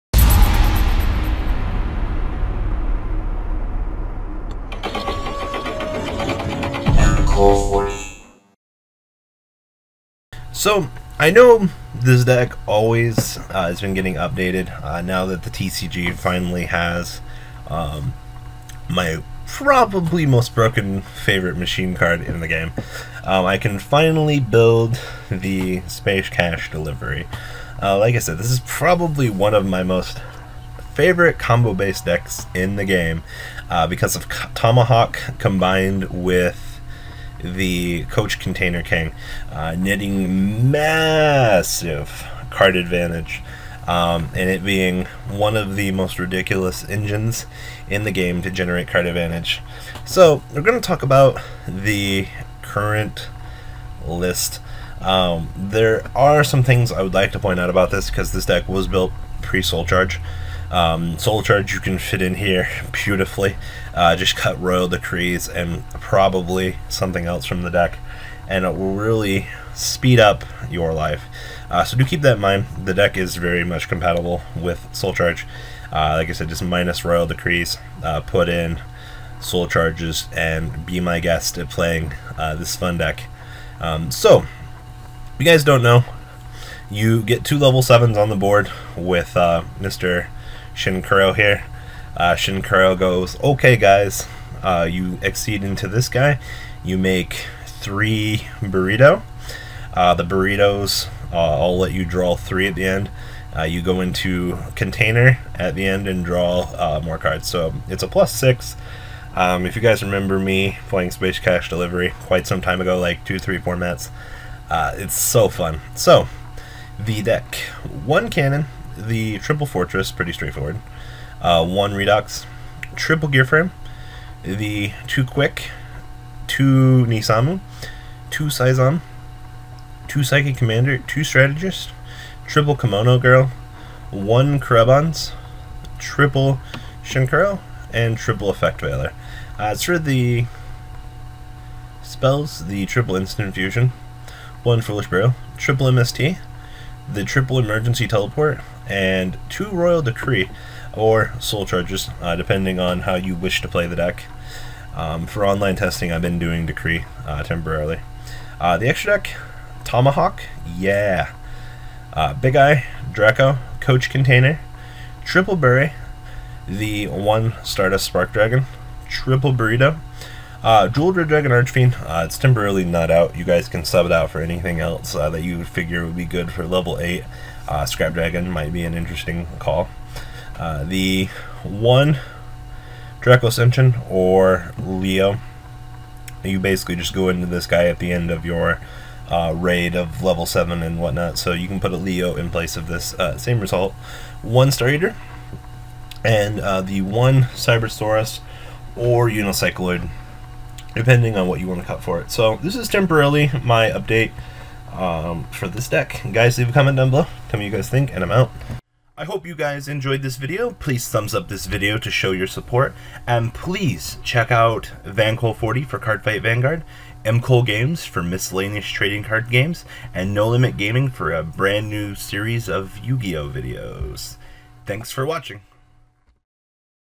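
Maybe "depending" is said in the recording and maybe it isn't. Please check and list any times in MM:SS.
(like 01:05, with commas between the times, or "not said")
02:32, 03:20.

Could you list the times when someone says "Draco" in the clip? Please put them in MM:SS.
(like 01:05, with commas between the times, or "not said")
02:43, 03:03.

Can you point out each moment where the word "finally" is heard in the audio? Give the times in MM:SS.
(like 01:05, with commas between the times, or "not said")
00:16, 00:23.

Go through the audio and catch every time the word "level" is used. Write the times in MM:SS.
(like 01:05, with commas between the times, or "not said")
01:27, 02:56, 03:10.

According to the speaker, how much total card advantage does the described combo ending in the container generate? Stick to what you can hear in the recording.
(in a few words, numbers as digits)
plus 6.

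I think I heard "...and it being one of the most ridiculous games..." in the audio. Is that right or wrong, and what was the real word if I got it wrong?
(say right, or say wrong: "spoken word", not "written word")
wrong: "engines", not "games".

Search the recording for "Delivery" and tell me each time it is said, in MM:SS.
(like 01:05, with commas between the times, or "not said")
00:26, 01:51.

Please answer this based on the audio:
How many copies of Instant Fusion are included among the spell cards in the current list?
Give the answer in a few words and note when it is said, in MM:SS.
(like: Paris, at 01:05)
3, at 02:22.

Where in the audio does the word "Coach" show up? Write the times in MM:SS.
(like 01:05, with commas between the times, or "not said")
00:38, 02:43.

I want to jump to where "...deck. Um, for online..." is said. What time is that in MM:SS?
02:33.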